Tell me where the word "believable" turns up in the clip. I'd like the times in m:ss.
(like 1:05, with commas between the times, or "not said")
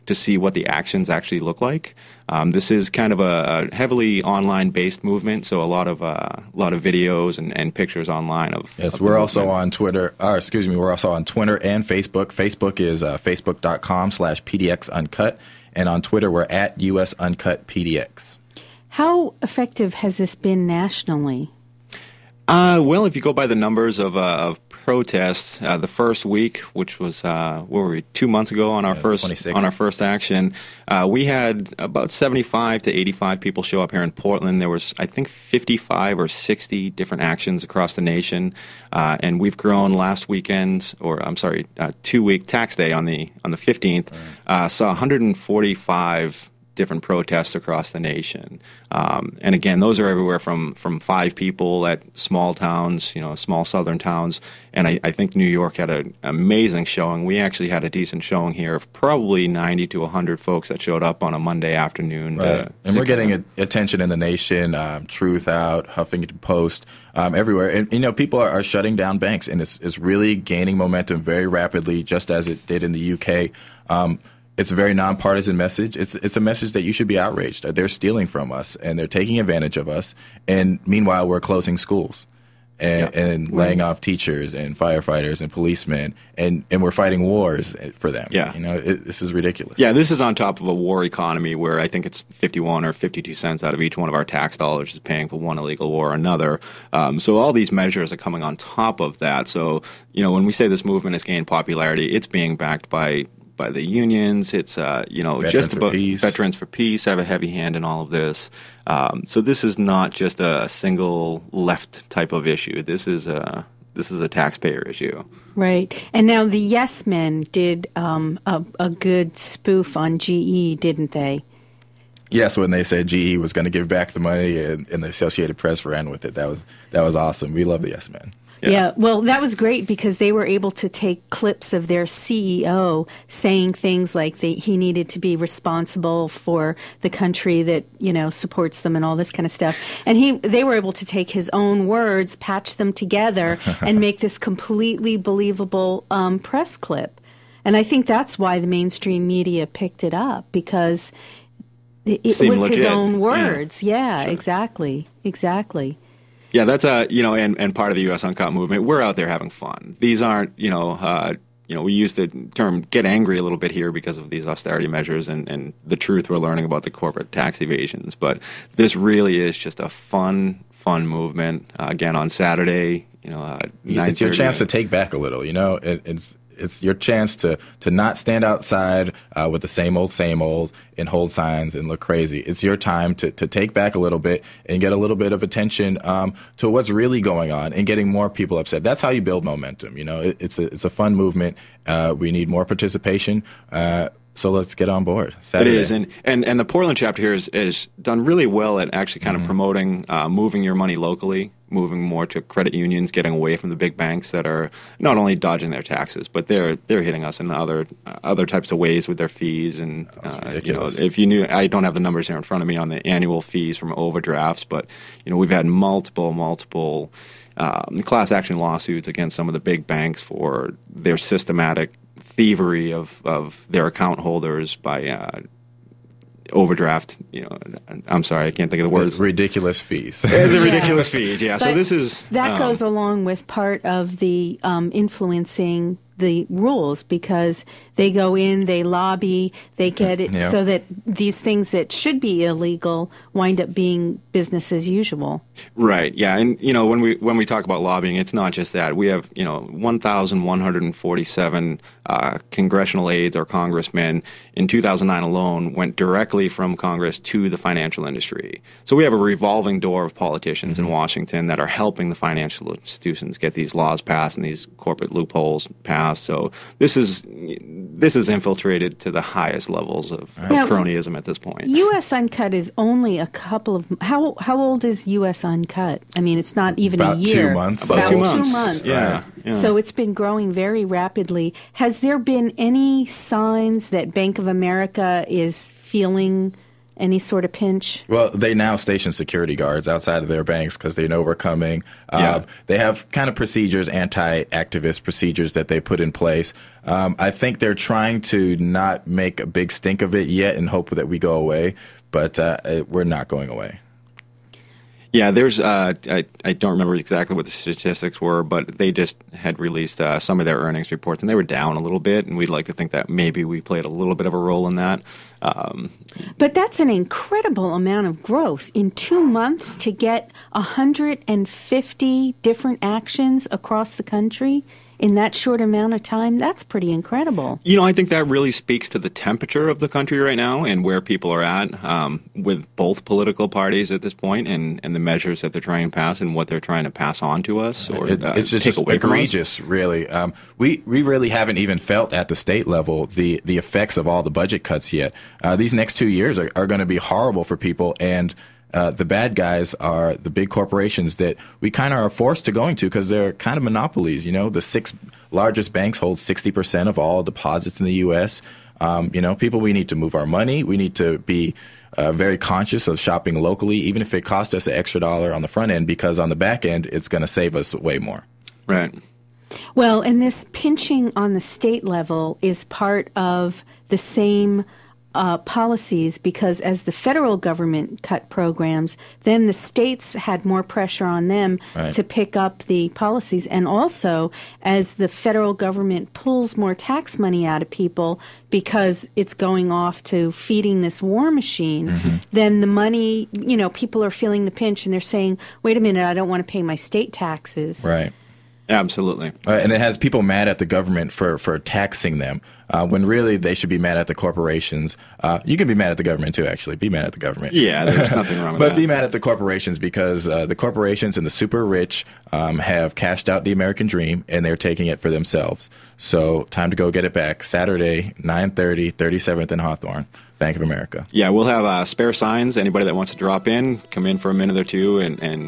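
2:25.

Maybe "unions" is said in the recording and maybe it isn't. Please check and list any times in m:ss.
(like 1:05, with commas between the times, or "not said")
1:43, 3:22.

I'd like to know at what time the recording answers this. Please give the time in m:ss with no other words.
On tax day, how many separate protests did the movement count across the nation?
0:44.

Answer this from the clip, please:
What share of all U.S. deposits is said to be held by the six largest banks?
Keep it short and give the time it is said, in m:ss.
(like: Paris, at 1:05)
60%, at 5:56.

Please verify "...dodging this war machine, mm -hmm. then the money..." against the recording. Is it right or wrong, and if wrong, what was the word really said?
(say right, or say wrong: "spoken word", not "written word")
wrong: "feeding", not "dodging".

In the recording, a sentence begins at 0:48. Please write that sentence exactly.
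Um, and again, those are everywhere from from five people at small towns, you know, small southern towns.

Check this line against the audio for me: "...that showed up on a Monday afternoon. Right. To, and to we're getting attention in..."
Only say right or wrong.
right.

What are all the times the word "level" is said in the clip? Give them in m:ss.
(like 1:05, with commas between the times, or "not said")
4:29, 5:42, 6:11.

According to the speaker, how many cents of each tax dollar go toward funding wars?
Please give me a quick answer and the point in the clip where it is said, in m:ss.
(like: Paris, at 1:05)
51 or 52 cents, at 1:32.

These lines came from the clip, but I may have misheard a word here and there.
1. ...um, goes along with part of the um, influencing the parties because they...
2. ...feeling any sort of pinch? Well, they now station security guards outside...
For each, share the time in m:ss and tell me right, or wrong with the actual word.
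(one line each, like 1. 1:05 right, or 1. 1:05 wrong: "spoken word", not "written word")
1. 3:52 wrong: "rules", not "parties"
2. 4:45 right.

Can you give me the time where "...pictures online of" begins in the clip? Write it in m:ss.
0:07.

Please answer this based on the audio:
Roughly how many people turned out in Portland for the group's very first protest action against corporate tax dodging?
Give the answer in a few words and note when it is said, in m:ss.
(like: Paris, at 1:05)
75 to 85, at 0:32.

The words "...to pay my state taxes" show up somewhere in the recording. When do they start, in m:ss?
6:36.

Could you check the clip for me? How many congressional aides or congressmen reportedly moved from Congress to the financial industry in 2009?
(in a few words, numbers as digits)
1,147.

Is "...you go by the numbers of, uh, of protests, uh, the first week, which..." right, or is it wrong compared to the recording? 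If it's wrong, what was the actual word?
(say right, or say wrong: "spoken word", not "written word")
right.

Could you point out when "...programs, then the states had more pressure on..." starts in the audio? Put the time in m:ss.
6:18.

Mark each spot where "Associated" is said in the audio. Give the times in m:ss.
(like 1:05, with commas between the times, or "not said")
2:05.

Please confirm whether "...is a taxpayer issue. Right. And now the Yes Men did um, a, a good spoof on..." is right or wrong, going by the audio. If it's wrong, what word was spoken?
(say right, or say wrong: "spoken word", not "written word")
right.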